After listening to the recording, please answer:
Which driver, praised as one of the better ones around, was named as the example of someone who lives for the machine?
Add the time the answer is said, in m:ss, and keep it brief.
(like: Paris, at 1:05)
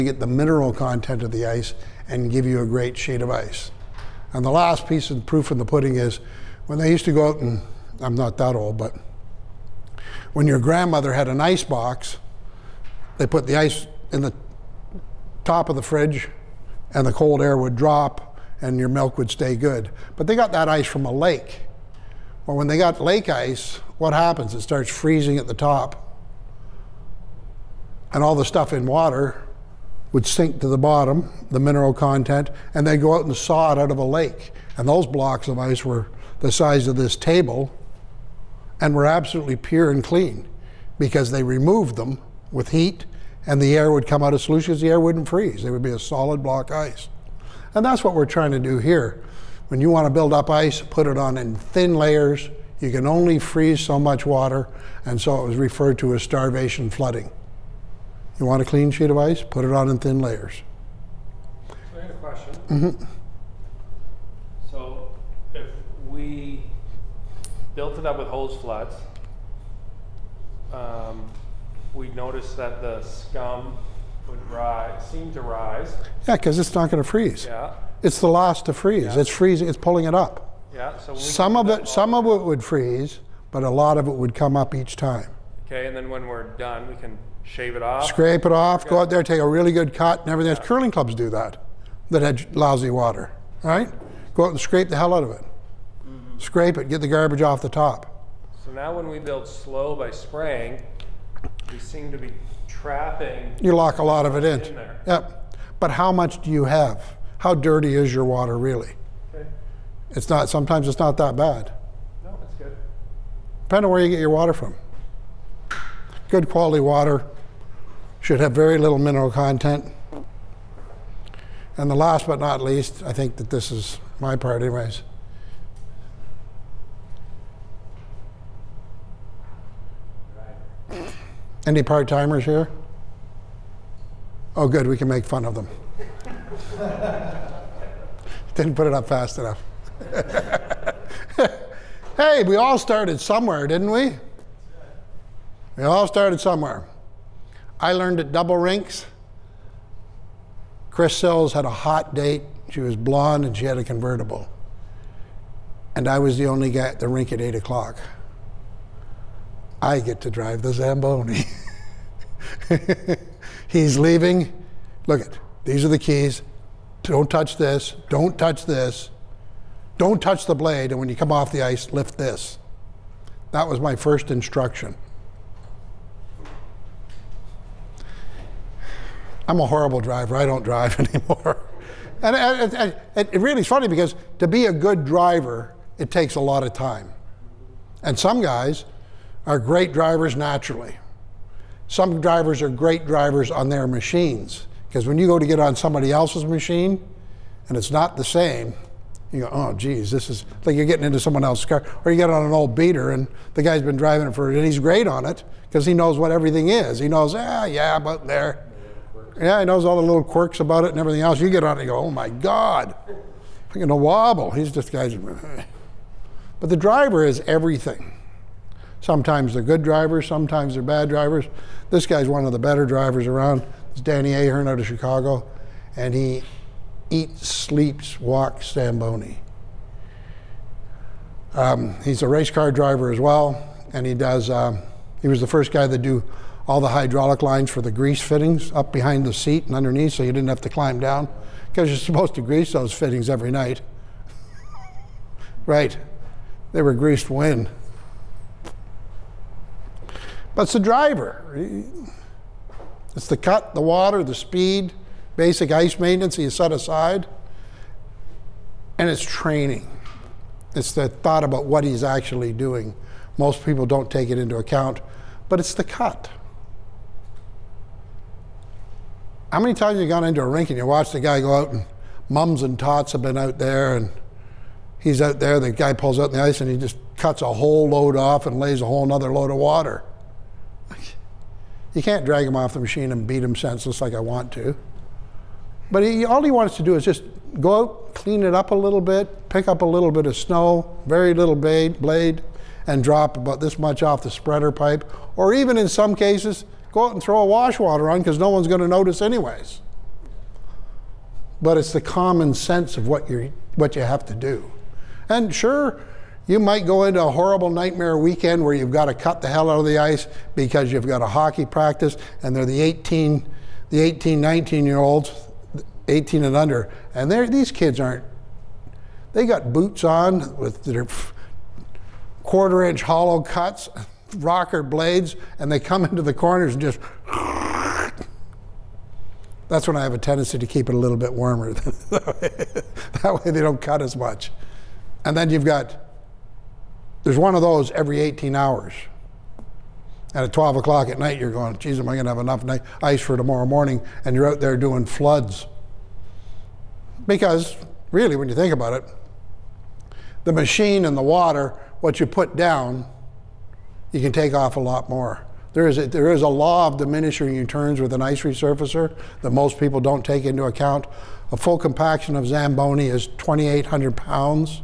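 Danny Ahern, at 3:43.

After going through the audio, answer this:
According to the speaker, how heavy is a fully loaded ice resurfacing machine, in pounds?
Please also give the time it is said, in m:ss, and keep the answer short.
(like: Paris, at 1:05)
2,800, at 6:03.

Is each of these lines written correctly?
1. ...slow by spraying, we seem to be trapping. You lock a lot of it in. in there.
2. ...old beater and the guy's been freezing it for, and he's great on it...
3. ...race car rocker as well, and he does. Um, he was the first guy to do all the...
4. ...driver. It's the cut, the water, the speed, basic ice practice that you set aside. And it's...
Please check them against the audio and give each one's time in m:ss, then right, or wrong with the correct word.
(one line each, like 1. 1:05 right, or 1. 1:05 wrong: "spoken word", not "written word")
1. 1:39 right
2. 3:22 wrong: "driving", not "freezing"
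3. 3:52 wrong: "driver", not "rocker"
4. 4:10 wrong: "maintenance", not "practice".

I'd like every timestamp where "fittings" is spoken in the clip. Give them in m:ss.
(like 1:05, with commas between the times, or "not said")
3:58, 4:02.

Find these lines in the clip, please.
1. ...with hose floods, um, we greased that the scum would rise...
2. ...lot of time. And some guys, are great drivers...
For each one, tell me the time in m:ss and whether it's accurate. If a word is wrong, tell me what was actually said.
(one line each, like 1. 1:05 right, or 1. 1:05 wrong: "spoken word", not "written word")
1. 1:08 wrong: "noticed", not "greased"
2. 3:06 right.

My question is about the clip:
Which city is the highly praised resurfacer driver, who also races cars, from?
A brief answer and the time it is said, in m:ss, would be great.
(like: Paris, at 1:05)
Chicago, at 3:44.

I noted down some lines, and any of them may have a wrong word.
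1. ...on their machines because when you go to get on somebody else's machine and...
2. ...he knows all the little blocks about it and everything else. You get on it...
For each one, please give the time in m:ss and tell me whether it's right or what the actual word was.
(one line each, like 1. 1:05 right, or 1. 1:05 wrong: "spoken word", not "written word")
1. 3:13 right
2. 3:29 wrong: "quirks", not "blocks".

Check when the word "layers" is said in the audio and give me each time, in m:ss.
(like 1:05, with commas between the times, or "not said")
0:51, 1:00.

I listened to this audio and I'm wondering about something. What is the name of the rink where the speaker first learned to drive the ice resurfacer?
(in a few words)
Double Rinks.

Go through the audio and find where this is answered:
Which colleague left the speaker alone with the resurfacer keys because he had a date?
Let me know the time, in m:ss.
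2:30.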